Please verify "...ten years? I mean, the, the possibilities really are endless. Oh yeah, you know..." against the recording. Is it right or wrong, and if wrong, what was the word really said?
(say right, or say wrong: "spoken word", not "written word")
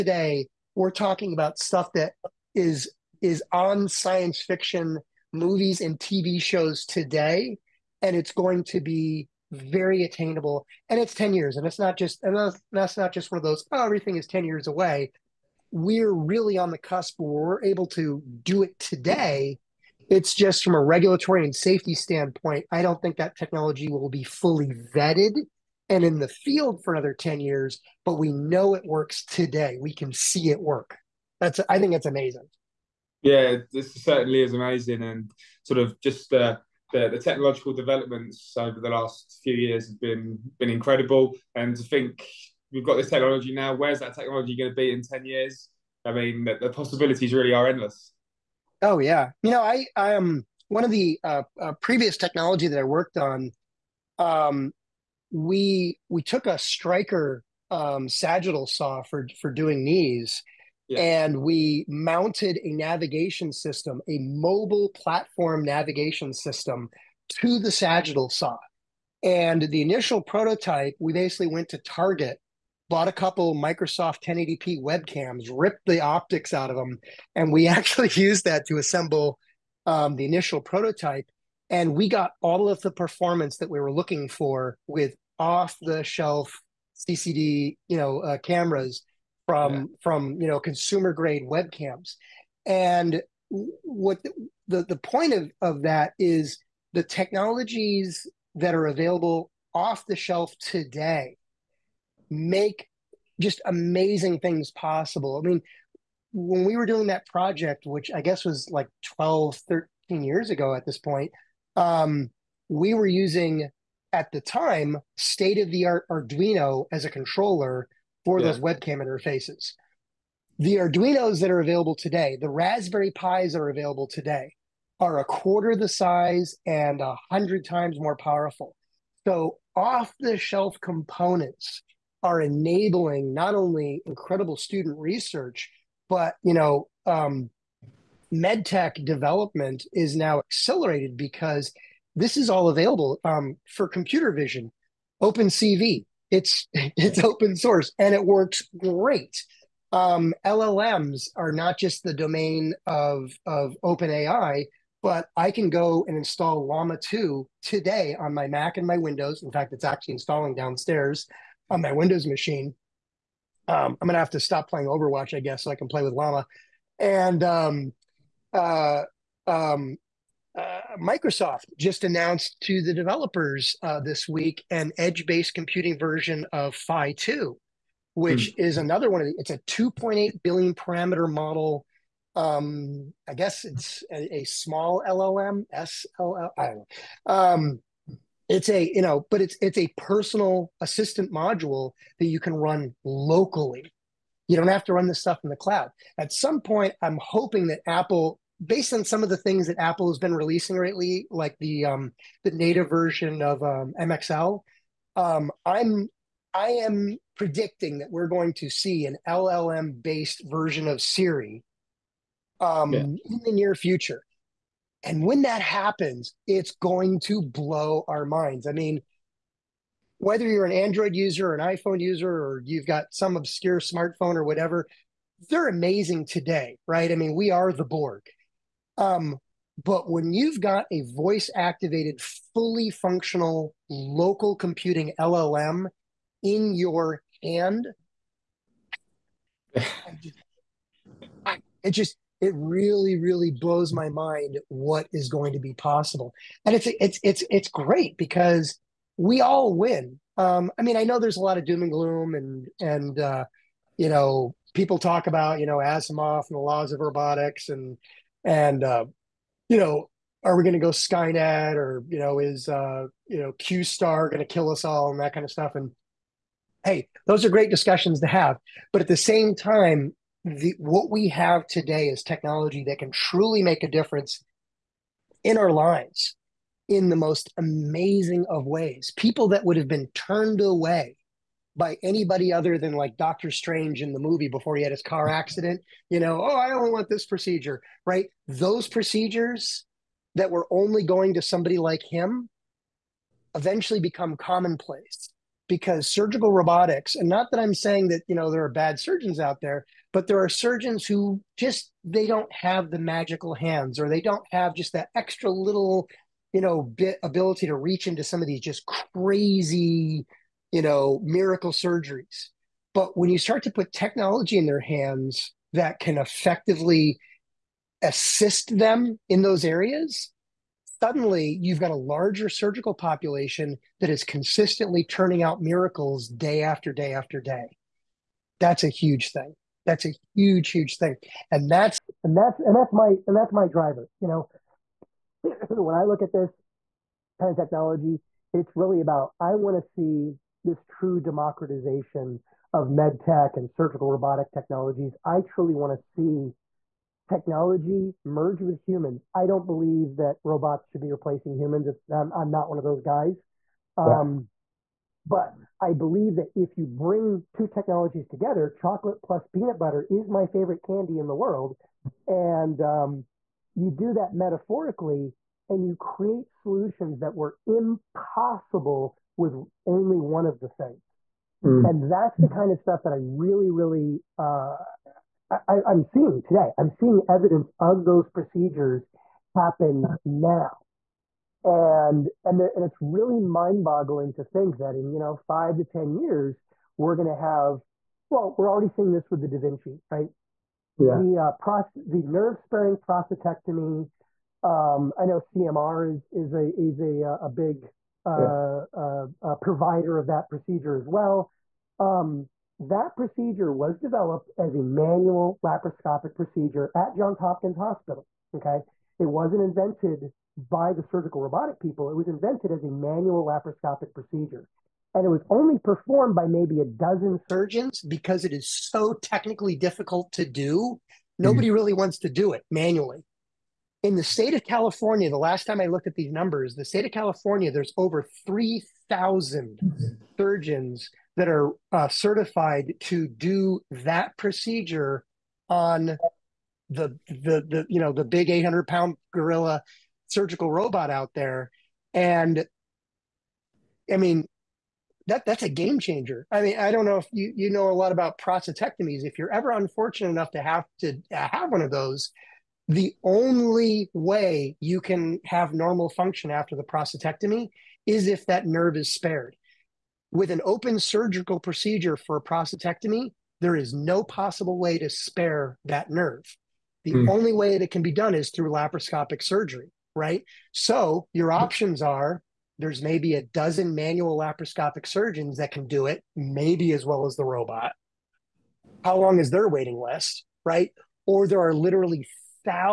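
right.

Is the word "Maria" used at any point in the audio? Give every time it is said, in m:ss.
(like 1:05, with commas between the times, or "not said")
not said.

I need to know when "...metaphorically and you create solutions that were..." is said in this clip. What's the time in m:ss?
6:04.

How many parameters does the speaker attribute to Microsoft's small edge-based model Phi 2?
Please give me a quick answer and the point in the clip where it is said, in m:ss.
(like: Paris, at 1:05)
2.8 billion, at 2:59.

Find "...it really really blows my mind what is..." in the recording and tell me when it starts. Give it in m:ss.
4:02.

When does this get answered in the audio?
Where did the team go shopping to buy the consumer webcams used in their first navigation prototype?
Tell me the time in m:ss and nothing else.
1:11.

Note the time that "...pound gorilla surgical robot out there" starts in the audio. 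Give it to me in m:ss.
7:18.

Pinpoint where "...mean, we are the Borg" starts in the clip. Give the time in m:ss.
3:47.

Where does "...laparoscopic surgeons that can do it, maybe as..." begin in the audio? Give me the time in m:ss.
7:54.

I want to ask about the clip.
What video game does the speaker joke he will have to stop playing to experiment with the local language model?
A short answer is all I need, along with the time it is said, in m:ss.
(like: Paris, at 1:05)
Overwatch, at 2:44.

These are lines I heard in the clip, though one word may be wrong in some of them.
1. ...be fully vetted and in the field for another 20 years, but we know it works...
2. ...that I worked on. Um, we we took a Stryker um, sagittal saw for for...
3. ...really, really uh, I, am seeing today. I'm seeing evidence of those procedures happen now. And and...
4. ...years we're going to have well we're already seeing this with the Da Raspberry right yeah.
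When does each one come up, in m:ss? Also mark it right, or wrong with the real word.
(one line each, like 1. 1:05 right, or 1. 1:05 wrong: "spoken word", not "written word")
1. 0:24 wrong: "10", not "20"
2. 0:52 right
3. 6:13 right
4. 6:26 wrong: "Vinci", not "Raspberry".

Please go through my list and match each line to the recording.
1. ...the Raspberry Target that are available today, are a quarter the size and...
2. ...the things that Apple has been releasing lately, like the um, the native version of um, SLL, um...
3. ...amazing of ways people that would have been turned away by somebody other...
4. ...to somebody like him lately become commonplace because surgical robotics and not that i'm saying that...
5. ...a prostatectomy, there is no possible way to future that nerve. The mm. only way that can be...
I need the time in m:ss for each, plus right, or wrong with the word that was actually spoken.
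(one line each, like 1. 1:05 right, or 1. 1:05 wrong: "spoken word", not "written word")
1. 2:02 wrong: "Pis", not "Target"
2. 3:19 wrong: "MXL", not "SLL"
3. 4:37 wrong: "anybody", not "somebody"
4. 4:51 wrong: "eventually", not "lately"
5. 7:42 wrong: "spare", not "future".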